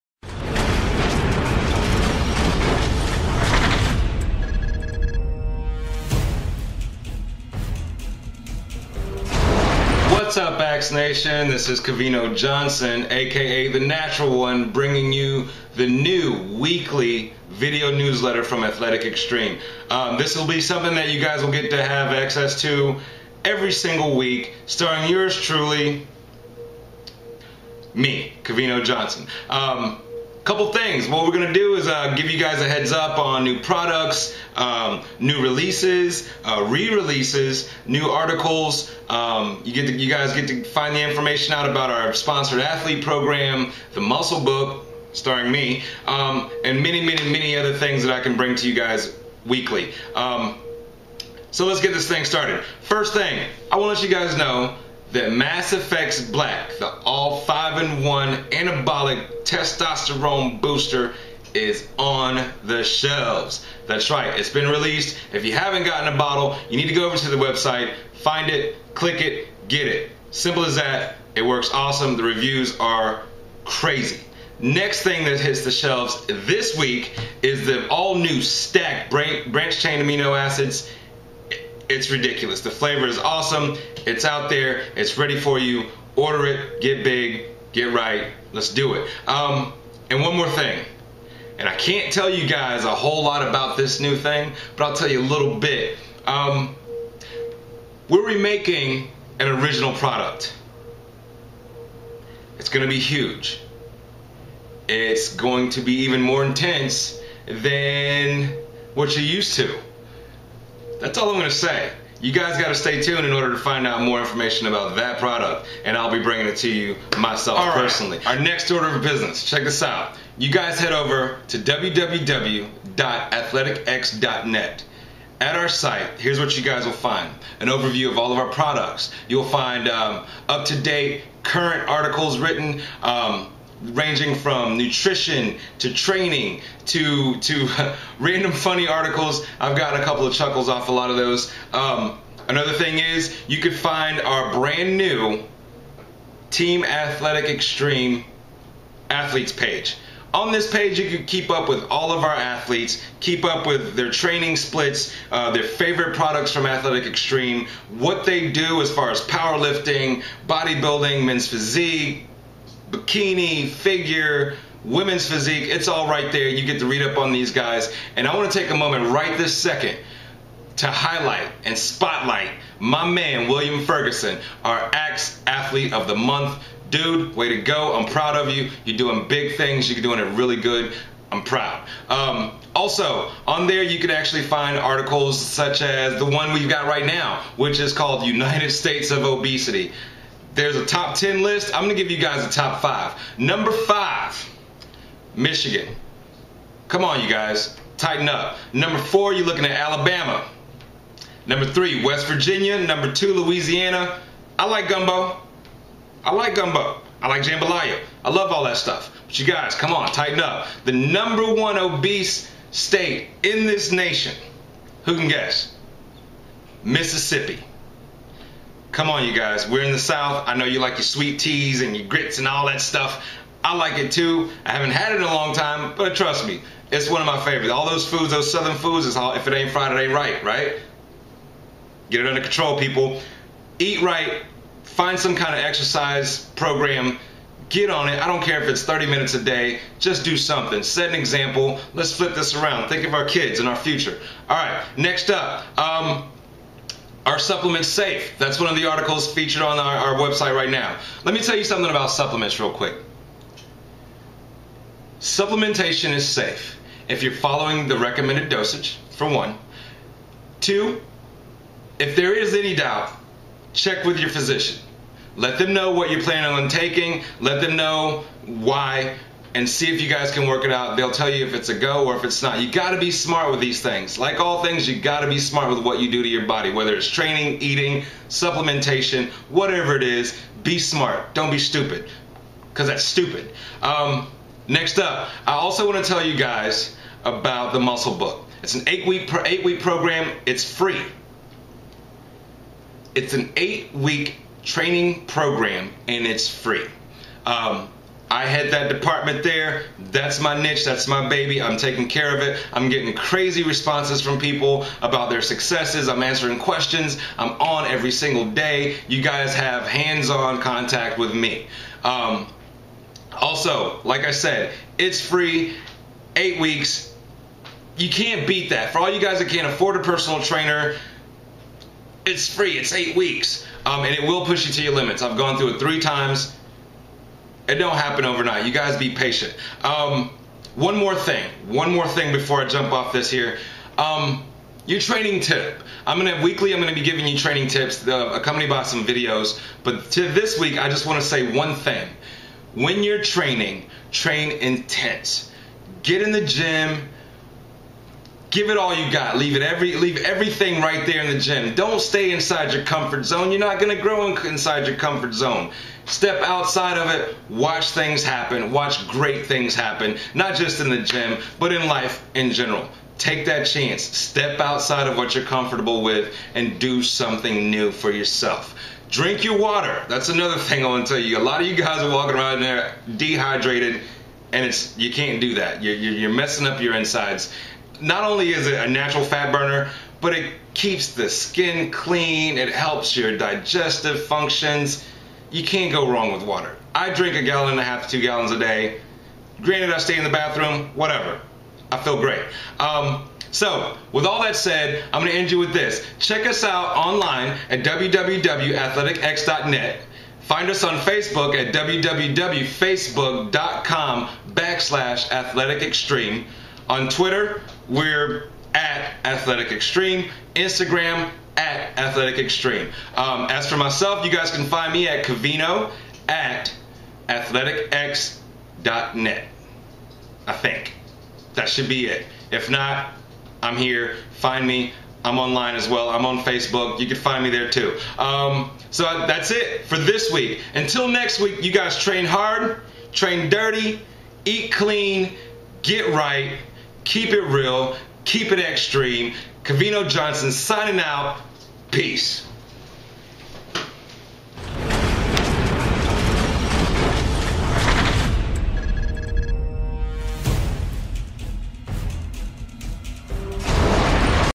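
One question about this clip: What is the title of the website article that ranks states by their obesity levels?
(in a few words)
United States of Obesity.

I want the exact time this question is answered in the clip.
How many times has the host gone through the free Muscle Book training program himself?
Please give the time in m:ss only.
5:25.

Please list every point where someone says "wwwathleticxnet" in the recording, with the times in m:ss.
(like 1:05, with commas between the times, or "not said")
2:01, 6:37.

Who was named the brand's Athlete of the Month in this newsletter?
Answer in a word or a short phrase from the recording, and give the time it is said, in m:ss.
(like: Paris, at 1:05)
William Ferguson, at 2:53.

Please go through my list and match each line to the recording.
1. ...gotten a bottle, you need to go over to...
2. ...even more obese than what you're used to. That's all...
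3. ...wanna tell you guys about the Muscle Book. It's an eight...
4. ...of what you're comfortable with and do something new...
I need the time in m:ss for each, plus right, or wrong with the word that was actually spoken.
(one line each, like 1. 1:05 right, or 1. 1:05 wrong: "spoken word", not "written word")
1. 1:05 right
2. 1:46 wrong: "intense", not "obese"
3. 4:45 right
4. 6:05 right.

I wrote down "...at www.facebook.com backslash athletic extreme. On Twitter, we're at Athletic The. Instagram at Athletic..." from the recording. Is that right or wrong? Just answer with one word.
wrong.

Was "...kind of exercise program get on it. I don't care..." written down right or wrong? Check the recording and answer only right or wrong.
right.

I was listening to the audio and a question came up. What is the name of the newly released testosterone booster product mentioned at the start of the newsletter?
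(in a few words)
MassFX Black.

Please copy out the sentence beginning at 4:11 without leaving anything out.
Let me tell you something about supplements, real quick.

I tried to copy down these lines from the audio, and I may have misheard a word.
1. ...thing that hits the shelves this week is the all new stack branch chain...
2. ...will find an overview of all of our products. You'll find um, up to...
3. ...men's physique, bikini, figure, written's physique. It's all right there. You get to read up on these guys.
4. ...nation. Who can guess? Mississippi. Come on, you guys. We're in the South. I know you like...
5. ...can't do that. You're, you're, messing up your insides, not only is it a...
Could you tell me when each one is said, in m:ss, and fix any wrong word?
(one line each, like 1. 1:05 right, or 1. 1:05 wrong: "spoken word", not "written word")
1. 1:15 right
2. 2:06 right
3. 2:41 wrong: "women", not "written"
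4. 3:33 right
5. 6:15 right.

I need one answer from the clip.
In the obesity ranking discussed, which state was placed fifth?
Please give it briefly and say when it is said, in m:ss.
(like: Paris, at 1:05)
Michigan, at 3:15.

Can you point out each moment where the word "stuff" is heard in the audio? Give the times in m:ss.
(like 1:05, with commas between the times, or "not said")
3:28, 3:42.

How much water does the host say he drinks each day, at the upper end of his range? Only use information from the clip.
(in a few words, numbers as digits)
2 gallons.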